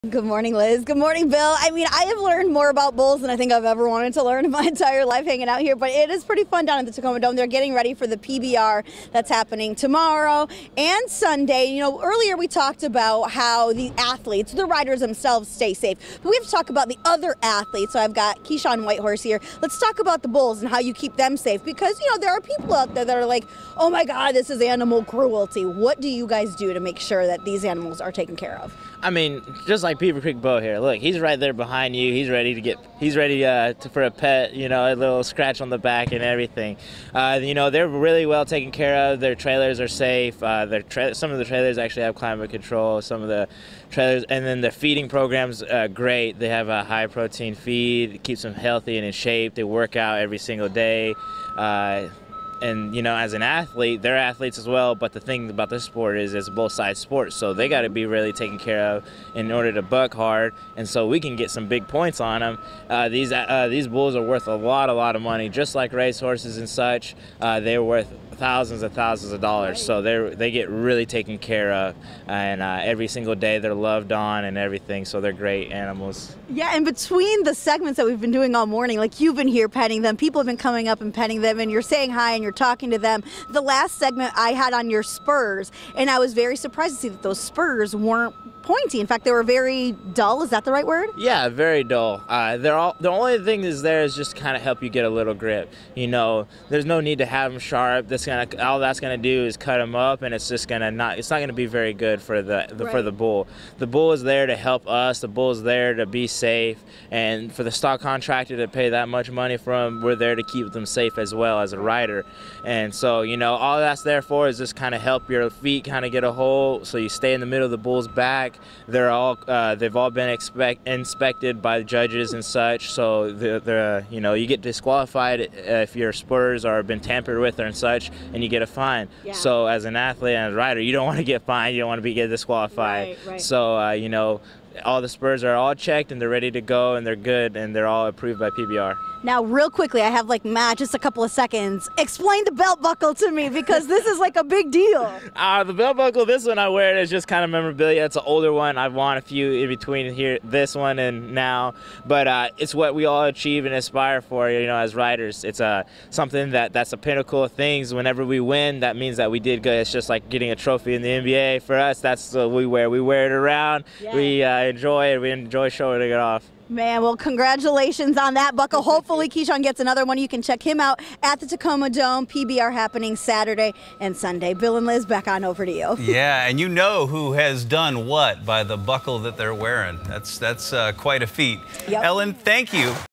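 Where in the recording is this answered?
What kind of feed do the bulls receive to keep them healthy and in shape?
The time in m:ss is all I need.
0:46.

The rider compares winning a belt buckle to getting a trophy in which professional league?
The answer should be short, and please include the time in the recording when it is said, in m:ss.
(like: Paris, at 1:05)
NBA, at 2:41.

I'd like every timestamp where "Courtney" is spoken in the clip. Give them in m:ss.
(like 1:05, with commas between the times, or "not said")
not said.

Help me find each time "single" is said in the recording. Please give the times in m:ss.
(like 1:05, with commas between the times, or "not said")
0:50, 1:13.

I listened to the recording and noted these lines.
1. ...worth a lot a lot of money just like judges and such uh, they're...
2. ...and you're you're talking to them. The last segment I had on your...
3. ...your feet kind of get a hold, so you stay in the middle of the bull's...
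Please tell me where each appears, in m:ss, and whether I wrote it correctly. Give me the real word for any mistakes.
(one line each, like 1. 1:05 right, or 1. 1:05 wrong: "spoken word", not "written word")
1. 1:04 wrong: "racehorses", not "judges"
2. 1:22 right
3. 1:55 right.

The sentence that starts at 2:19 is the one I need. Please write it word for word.
Now, real quickly, I have like Matt, just a couple of seconds.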